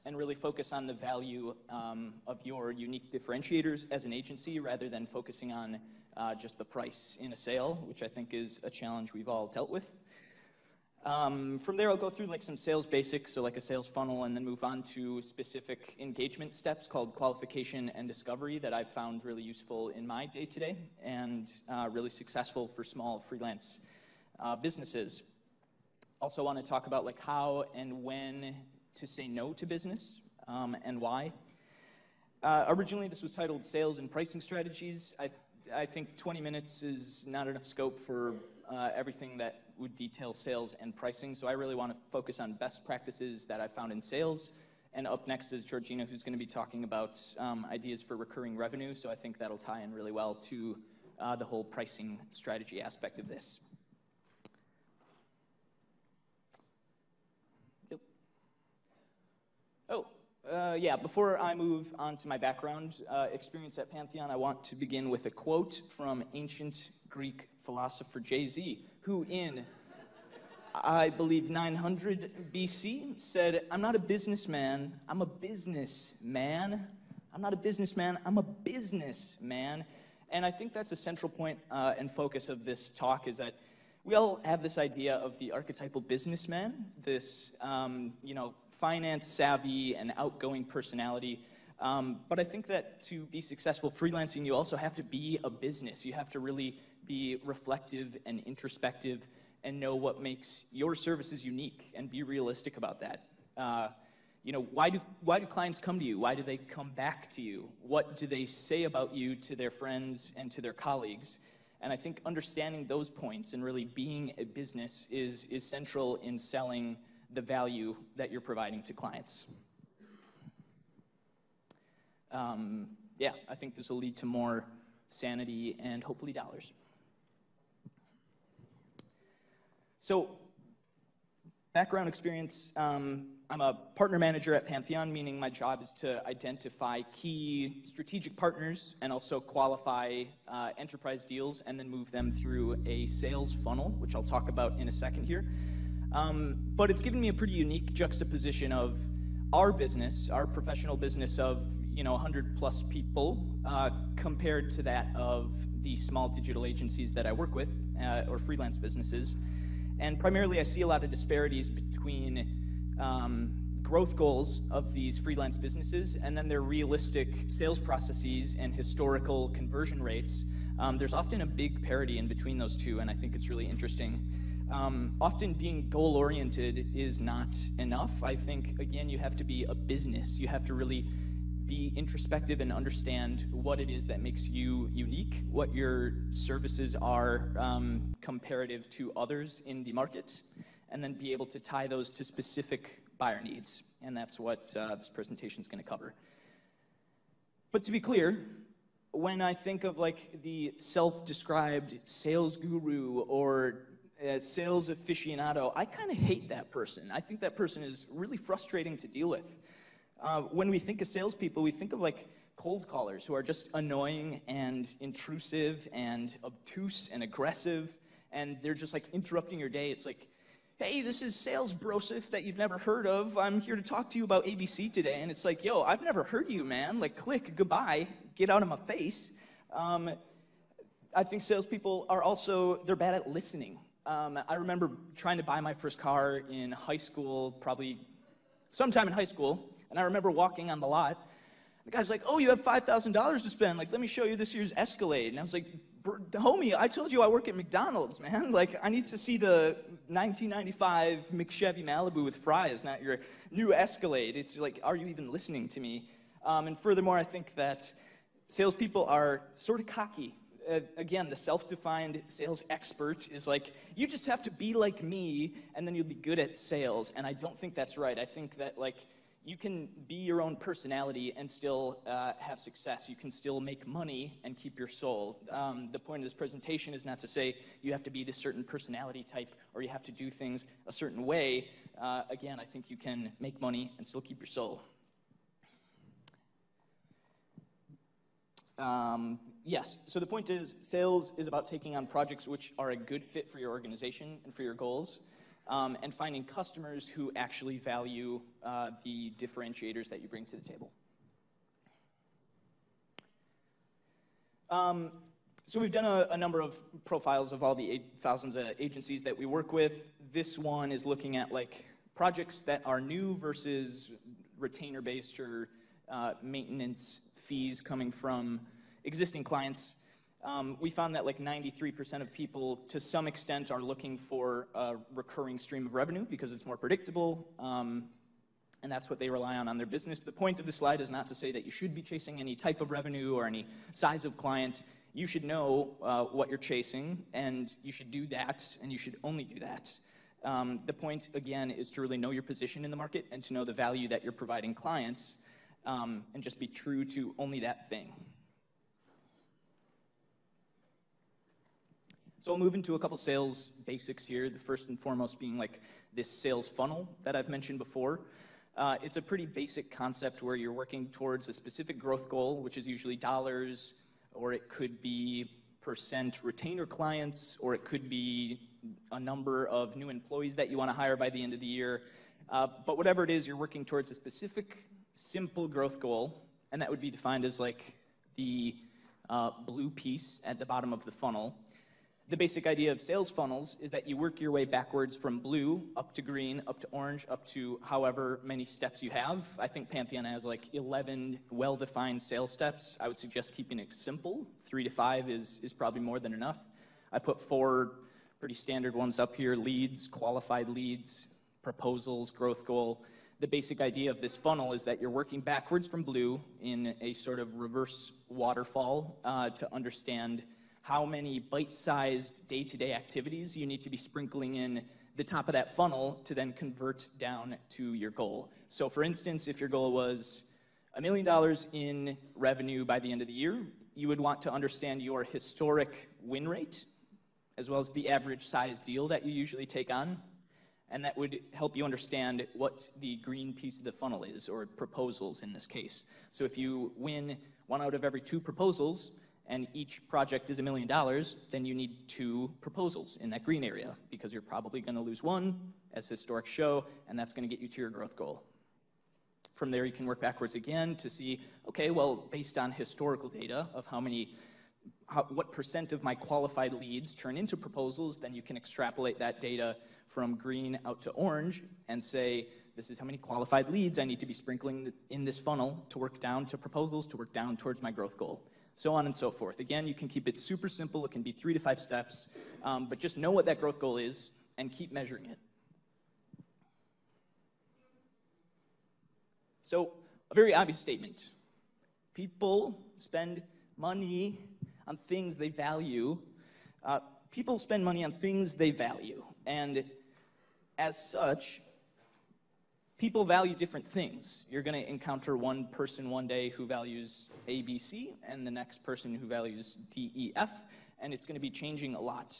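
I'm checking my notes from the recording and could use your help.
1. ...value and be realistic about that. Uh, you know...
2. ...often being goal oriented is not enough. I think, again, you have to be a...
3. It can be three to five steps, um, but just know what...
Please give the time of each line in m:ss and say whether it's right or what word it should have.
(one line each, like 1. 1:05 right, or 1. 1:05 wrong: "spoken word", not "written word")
1. 1:41 wrong: "unique", not "value"
2. 2:55 right
3. 7:51 right.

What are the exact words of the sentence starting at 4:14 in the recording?
It's like, are you even listening to me?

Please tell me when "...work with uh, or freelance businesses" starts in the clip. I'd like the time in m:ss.
2:37.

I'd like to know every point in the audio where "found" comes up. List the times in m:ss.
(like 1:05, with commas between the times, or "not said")
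0:18, 0:43, 5:20.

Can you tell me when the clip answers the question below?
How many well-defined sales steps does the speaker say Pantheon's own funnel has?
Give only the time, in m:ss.
6:30.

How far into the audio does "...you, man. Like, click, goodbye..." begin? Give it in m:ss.
3:46.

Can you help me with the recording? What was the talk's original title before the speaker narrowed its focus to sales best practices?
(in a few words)
Sales and Pricing Strategies.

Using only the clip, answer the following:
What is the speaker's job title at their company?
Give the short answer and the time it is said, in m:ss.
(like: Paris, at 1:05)
Partner manager, at 2:13.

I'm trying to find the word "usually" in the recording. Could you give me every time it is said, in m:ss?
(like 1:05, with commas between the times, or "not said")
6:02, 7:09.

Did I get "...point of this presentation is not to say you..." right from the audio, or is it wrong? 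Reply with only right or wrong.
right.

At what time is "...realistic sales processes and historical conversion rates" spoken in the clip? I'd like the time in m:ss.
2:46.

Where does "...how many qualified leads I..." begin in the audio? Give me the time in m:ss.
7:42.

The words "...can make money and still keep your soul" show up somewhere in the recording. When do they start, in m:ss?
4:42.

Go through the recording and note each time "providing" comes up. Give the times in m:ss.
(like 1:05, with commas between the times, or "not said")
1:58, 5:44.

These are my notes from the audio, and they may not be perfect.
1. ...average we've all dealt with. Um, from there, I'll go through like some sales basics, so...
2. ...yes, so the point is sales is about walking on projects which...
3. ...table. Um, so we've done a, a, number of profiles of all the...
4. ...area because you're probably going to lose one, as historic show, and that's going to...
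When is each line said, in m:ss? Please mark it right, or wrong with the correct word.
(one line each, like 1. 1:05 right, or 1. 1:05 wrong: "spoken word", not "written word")
1. 0:08 wrong: "challenge", not "average"
2. 4:49 wrong: "taking", not "walking"
3. 5:00 right
4. 7:23 right.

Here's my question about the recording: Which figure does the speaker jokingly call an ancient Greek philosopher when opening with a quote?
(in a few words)
Jay Z.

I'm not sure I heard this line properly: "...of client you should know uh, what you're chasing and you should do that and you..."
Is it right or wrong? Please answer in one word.
right.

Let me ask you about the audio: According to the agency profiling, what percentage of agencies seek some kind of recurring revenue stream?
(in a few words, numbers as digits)
93%.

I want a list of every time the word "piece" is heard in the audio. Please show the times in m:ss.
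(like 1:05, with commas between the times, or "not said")
6:19, 7:13.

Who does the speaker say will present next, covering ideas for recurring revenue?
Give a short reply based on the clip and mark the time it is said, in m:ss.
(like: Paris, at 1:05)
Georgina, at 0:45.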